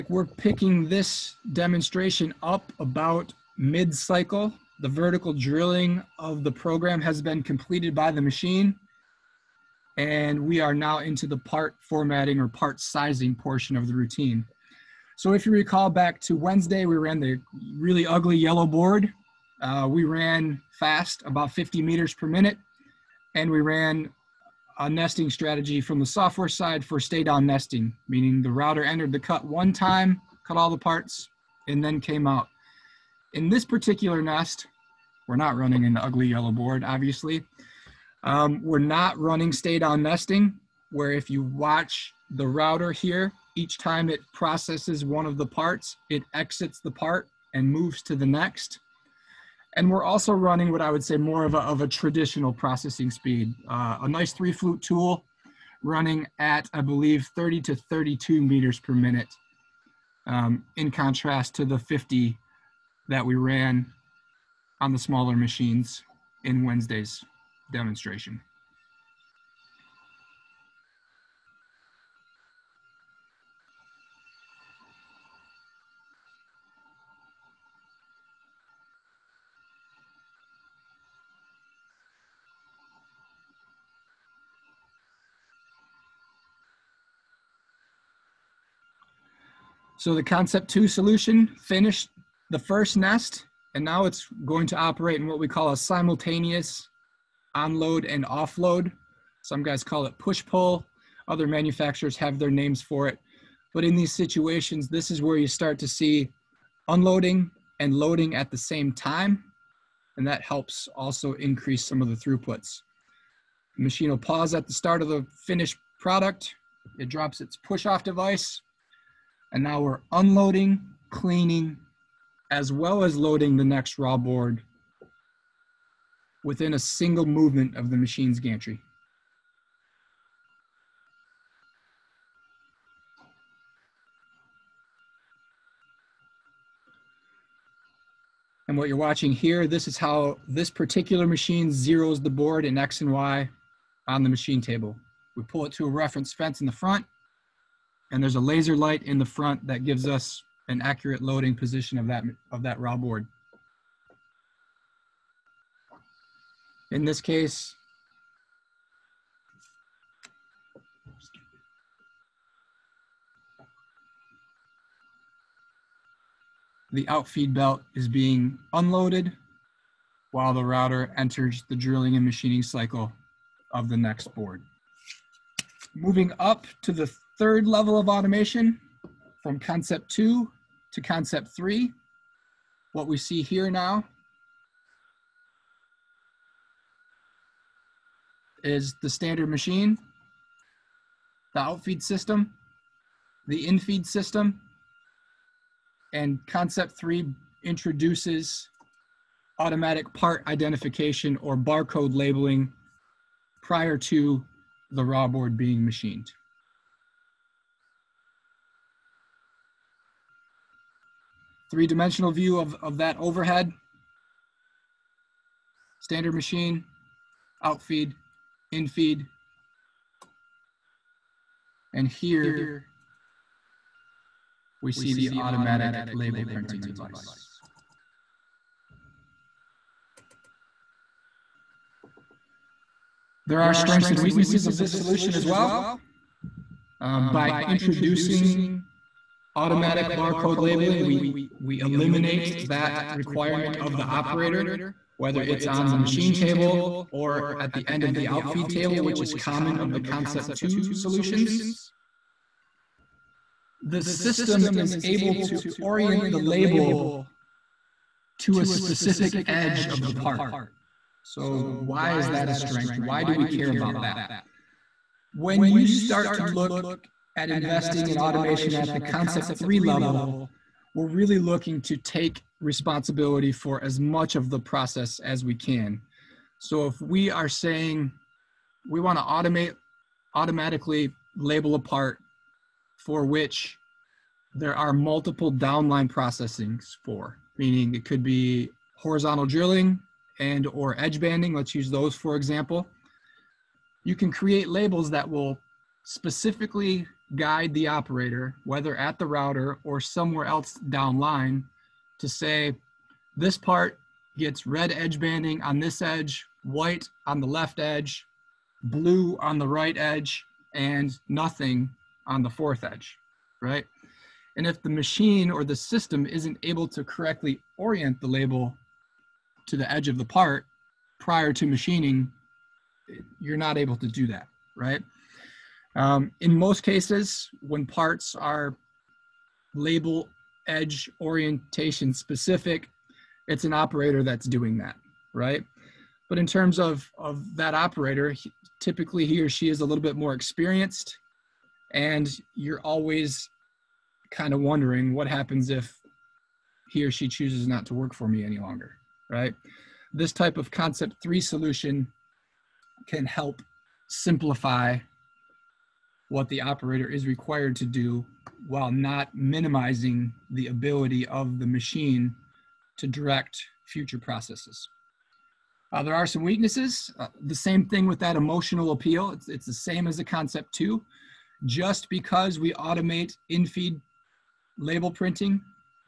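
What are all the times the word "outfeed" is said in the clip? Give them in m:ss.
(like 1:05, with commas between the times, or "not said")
2:47, 3:11, 3:37, 4:08.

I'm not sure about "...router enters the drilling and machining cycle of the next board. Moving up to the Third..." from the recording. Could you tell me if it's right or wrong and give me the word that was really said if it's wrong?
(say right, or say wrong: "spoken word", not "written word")
right.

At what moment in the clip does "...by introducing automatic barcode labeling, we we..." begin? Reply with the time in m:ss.
3:57.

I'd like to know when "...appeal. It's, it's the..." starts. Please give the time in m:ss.
6:08.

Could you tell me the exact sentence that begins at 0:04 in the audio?
The vertical drilling of the program has been completed by the machine.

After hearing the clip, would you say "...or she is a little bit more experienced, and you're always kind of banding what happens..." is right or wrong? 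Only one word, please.
wrong.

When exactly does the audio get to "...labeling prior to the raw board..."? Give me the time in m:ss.
3:22.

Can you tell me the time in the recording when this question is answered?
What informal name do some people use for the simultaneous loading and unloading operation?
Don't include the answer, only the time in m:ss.
1:40.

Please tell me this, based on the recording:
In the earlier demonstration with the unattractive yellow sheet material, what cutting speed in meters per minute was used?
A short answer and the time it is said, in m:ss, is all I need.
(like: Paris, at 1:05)
50, at 0:21.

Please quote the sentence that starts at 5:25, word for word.
Um, in most cases, when parts are label edge orientation specific, it's an operator that's doing that, right?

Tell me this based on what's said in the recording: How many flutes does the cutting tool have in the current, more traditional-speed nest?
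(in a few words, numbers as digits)
3.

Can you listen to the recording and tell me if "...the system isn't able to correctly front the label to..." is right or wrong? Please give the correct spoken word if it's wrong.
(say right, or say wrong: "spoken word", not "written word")
wrong: "orient", not "front".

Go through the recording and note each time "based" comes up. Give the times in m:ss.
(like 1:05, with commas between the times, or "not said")
not said.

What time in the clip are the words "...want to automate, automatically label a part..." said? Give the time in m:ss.
4:38.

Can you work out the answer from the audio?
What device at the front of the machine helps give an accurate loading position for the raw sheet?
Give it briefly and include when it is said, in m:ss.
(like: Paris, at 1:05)
laser light, at 2:28.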